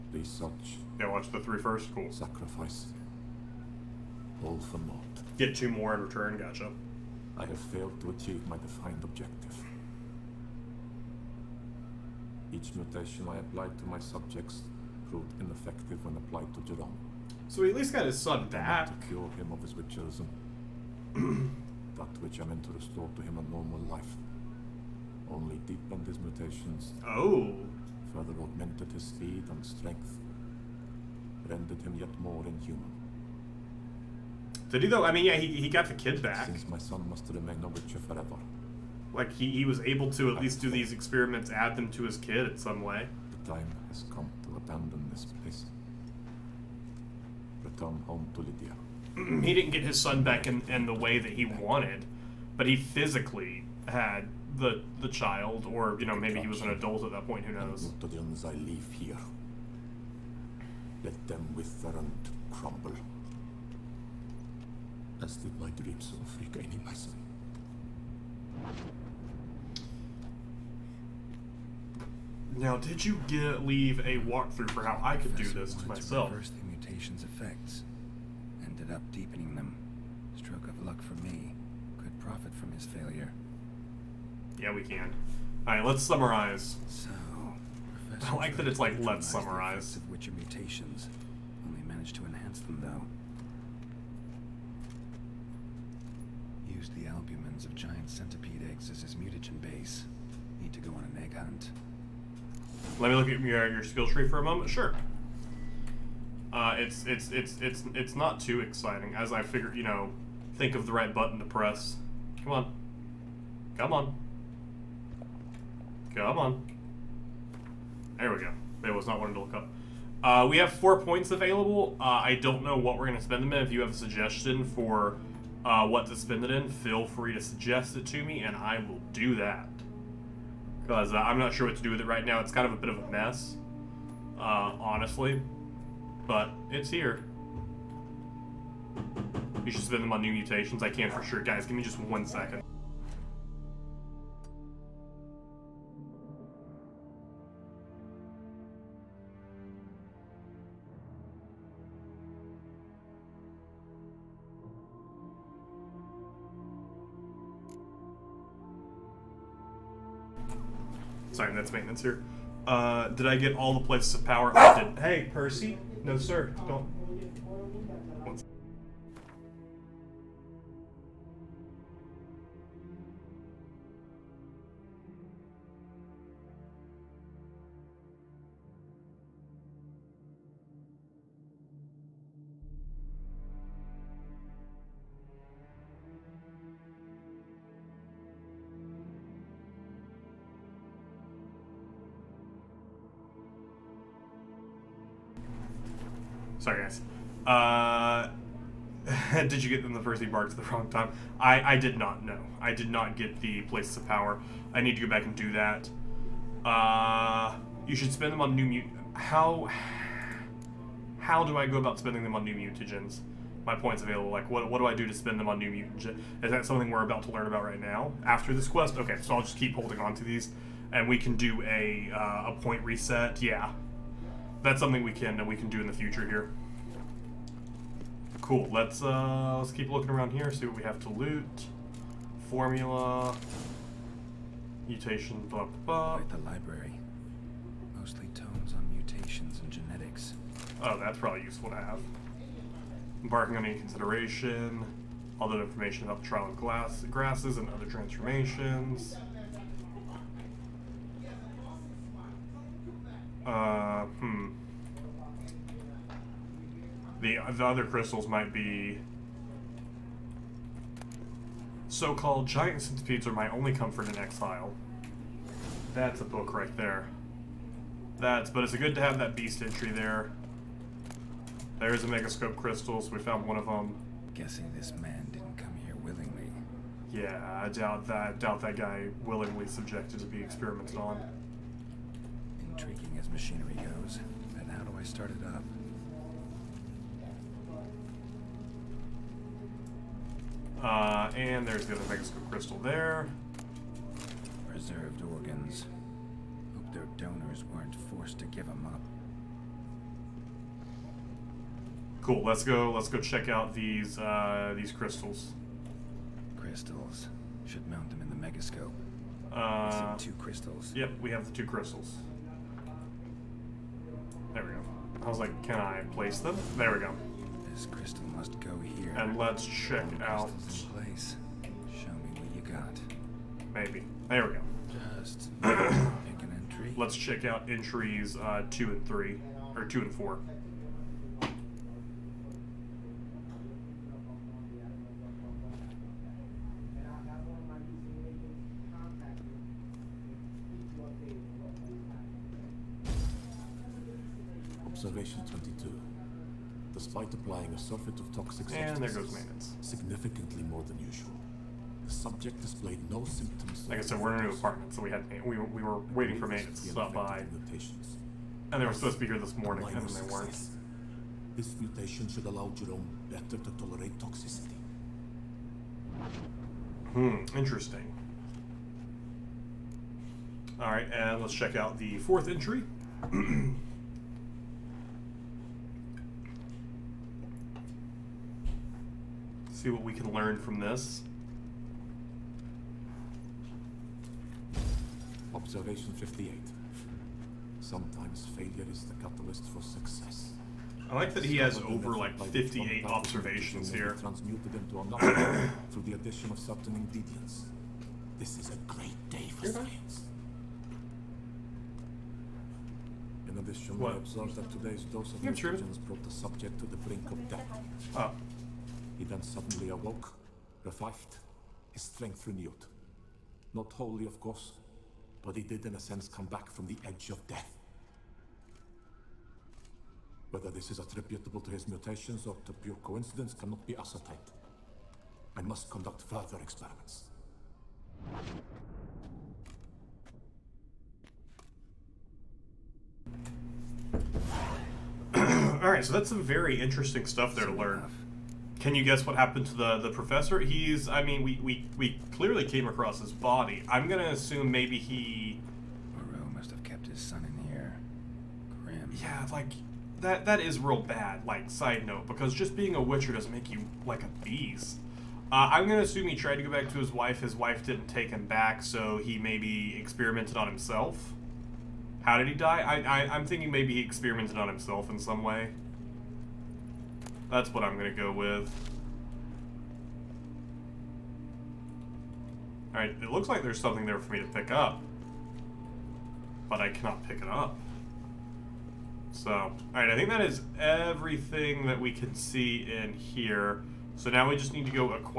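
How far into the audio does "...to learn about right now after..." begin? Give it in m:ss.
3:37.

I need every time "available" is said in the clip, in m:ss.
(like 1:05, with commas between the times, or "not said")
2:01, 3:34.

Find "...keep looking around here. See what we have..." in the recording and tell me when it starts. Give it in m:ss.
3:49.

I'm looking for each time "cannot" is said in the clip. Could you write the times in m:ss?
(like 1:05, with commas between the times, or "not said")
7:03, 7:56.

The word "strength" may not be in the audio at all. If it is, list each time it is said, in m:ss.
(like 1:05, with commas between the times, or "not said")
0:29, 6:52.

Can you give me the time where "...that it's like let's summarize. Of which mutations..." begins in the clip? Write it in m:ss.
1:28.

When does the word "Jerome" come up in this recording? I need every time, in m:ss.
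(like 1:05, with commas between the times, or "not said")
0:16, 6:02.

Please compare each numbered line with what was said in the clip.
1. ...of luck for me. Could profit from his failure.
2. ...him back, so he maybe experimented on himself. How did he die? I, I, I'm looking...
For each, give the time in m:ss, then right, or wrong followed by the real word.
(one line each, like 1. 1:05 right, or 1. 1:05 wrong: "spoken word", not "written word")
1. 1:20 right
2. 7:38 wrong: "thinking", not "looking".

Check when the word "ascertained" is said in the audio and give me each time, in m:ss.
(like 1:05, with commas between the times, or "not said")
7:03.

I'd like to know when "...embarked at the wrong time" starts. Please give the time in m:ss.
3:20.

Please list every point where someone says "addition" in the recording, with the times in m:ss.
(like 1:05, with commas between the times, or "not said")
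6:36, 6:43.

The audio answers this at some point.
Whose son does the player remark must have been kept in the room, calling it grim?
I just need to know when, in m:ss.
7:26.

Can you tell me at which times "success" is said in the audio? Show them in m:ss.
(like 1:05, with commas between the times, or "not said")
6:00, 6:29.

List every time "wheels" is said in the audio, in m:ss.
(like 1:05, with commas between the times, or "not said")
not said.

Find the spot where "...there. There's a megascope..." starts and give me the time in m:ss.
4:29.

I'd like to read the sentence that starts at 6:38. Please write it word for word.
This is a great day for science.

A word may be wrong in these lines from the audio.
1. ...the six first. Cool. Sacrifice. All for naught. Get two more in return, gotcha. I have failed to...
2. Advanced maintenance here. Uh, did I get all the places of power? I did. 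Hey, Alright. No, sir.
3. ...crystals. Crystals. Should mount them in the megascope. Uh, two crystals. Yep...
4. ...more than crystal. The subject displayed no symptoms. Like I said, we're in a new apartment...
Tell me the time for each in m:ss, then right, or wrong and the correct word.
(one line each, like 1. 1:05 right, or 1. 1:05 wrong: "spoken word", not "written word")
1. 0:01 wrong: "three", not "six"
2. 2:41 wrong: "Percy", not "Alright"
3. 5:04 right
4. 5:50 wrong: "usual", not "crystal".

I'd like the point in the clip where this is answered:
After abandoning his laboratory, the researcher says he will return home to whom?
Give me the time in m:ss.
0:48.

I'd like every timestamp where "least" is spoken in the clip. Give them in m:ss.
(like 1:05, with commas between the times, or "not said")
0:17, 0:40.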